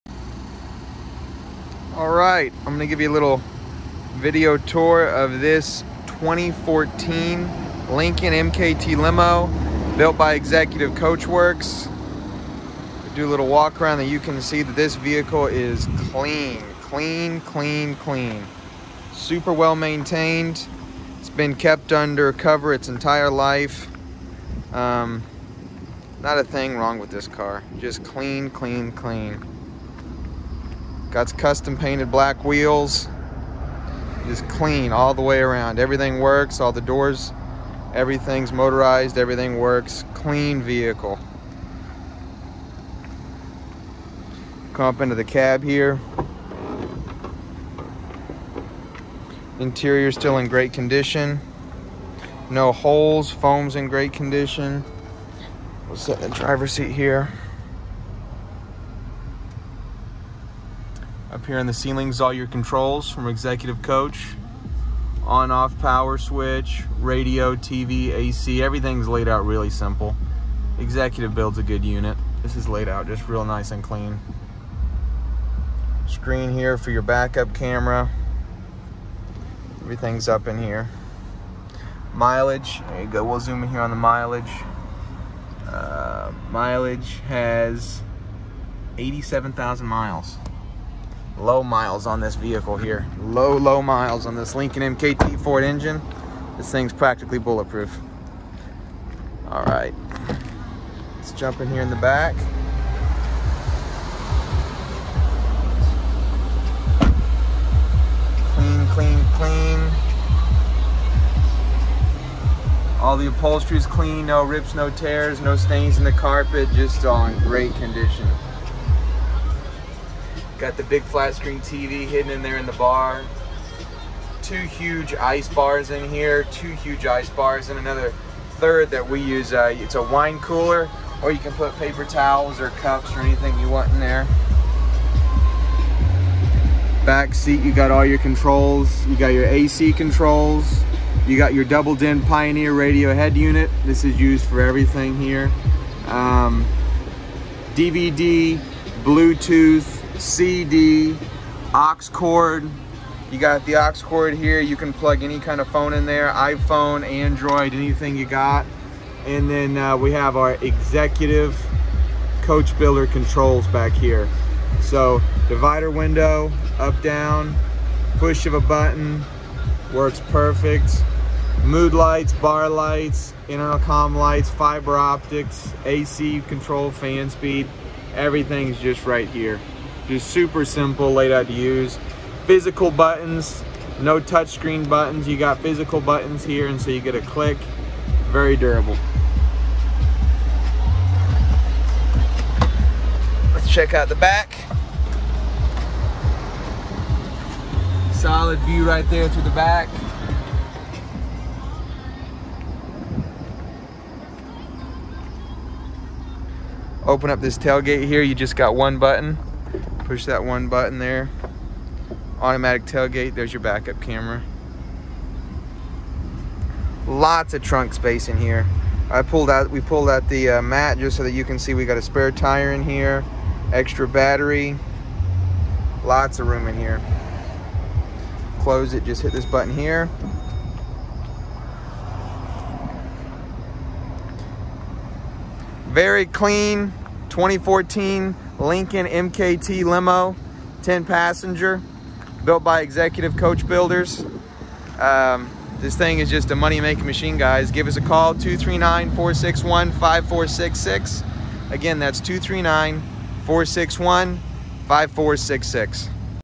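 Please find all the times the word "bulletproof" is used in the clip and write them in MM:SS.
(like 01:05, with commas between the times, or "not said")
01:37.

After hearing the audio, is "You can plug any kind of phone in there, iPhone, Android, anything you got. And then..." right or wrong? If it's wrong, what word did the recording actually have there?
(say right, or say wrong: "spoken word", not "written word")
right.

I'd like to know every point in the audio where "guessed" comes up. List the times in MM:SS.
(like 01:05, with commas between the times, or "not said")
not said.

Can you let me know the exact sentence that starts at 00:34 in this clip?
Just clean all the way around.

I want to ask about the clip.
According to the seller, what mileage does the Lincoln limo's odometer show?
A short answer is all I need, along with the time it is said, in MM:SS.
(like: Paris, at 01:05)
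87,000, at 01:28.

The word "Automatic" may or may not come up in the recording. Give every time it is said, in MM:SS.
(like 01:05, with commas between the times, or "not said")
03:32.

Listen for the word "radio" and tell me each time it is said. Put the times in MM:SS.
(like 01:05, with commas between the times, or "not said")
01:06, 02:22.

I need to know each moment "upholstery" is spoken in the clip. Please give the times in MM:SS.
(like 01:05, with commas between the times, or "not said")
01:53.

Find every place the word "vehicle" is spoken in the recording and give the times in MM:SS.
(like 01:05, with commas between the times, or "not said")
00:14, 00:40, 01:32.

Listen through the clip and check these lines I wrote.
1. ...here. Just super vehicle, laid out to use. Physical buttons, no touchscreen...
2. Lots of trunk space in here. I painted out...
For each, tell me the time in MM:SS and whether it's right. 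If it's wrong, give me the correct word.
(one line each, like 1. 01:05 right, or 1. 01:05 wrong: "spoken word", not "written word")
1. 02:59 wrong: "simple", not "vehicle"
2. 03:37 wrong: "pulled", not "painted".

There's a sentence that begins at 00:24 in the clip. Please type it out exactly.
Um, not a thing wrong with this car.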